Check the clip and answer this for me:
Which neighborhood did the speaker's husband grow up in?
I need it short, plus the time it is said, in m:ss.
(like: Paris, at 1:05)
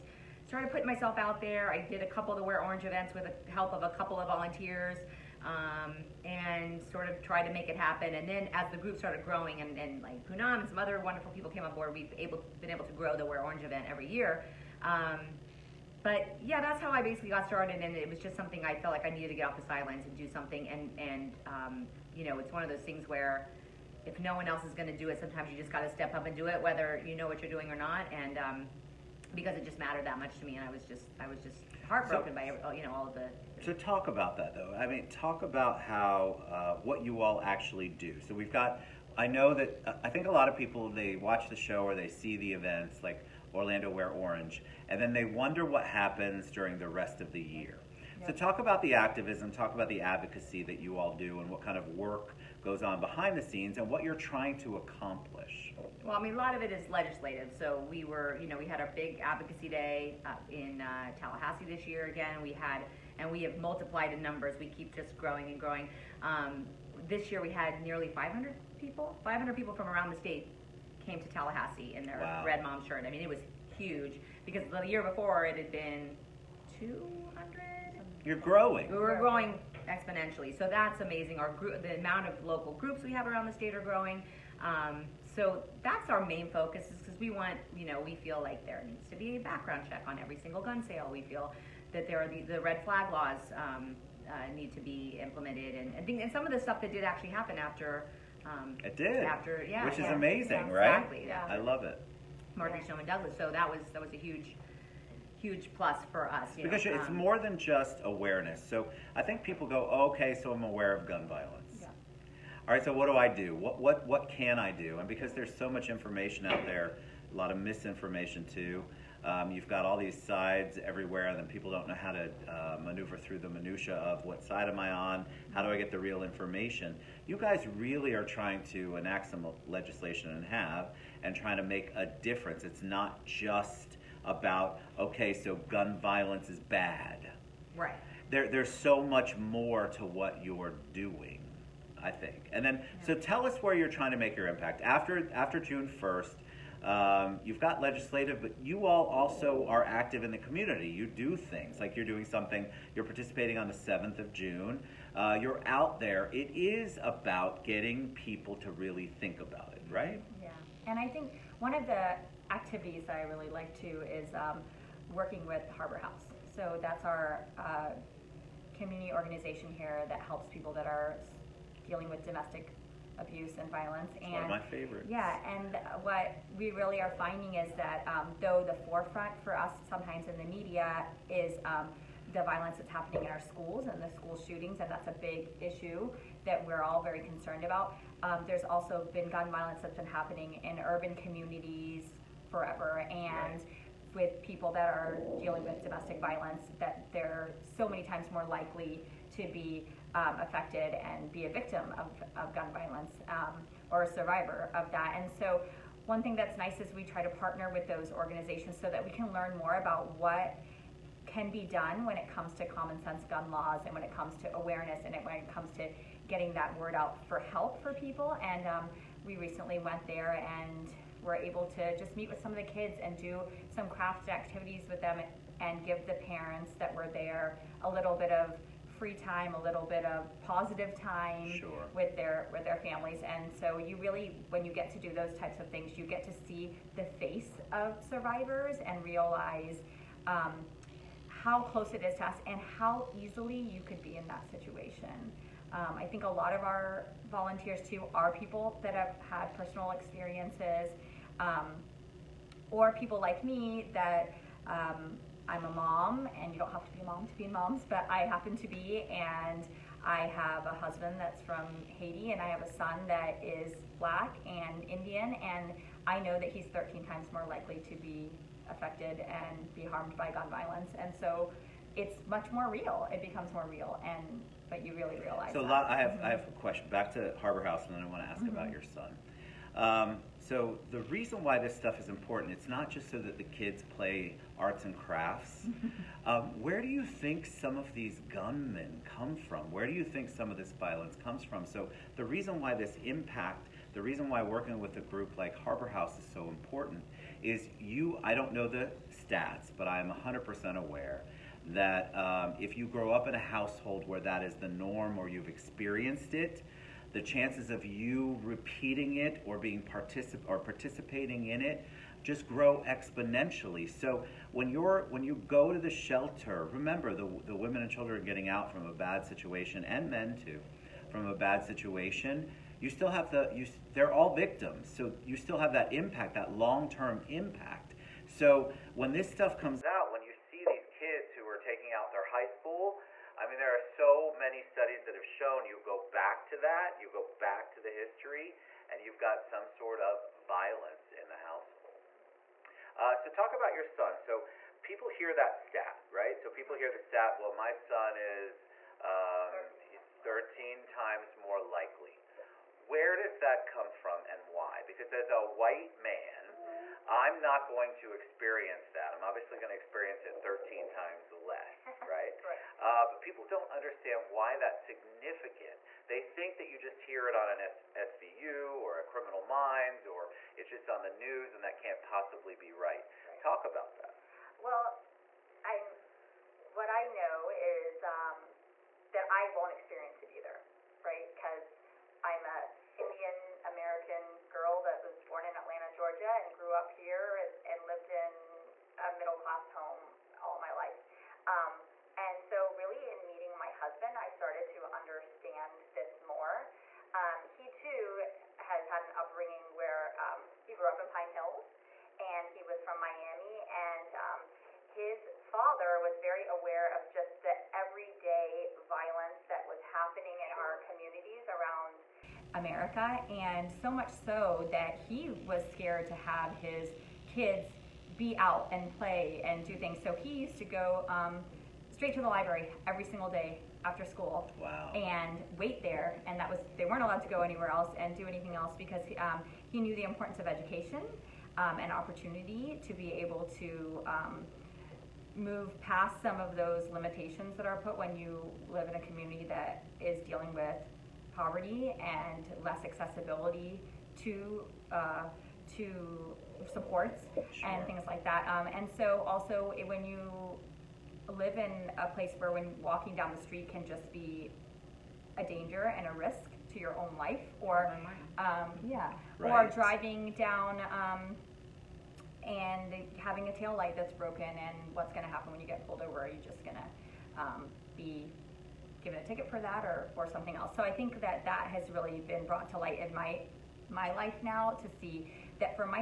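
Pine Hills, at 6:41.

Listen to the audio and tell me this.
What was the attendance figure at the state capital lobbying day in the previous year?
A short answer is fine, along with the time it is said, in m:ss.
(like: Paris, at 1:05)
200, at 1:16.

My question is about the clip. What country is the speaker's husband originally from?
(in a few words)
Haiti.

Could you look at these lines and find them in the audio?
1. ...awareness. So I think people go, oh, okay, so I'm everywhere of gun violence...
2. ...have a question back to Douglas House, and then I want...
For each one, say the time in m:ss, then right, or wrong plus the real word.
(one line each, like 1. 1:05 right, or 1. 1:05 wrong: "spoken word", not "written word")
1. 1:48 wrong: "aware", not "everywhere"
2. 4:36 wrong: "Harbor", not "Douglas".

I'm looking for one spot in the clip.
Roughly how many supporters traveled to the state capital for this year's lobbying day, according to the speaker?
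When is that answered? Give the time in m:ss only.
1:07.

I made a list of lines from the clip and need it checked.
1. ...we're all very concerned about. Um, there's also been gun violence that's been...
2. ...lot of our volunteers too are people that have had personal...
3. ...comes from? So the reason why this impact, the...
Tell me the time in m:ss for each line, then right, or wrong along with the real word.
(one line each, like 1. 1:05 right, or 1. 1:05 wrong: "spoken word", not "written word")
1. 3:06 right
2. 4:06 right
3. 4:51 right.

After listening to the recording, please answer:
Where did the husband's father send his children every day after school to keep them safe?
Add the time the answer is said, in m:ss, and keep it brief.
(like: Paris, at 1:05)
the library, at 7:02.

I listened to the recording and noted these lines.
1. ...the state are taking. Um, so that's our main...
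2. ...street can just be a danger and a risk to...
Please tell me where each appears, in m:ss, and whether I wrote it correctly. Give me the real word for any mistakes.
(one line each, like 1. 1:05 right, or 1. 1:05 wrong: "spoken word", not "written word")
1. 1:23 wrong: "growing", not "taking"
2. 7:33 right.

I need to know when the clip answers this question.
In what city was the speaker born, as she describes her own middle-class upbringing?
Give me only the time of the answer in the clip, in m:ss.
6:25.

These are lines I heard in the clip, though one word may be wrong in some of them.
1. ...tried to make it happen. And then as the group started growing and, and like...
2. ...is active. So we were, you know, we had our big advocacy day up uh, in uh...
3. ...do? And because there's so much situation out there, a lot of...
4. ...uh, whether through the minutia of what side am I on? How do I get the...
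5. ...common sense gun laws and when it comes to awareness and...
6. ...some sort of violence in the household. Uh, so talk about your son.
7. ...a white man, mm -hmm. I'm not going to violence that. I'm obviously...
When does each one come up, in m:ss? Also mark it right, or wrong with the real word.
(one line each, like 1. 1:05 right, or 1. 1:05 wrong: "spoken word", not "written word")
1. 0:07 right
2. 0:56 wrong: "legislative", not "active"
3. 1:54 wrong: "information", not "situation"
4. 2:02 wrong: "maneuver", not "whether"
5. 3:32 right
6. 5:39 right
7. 5:55 wrong: "experience", not "violence".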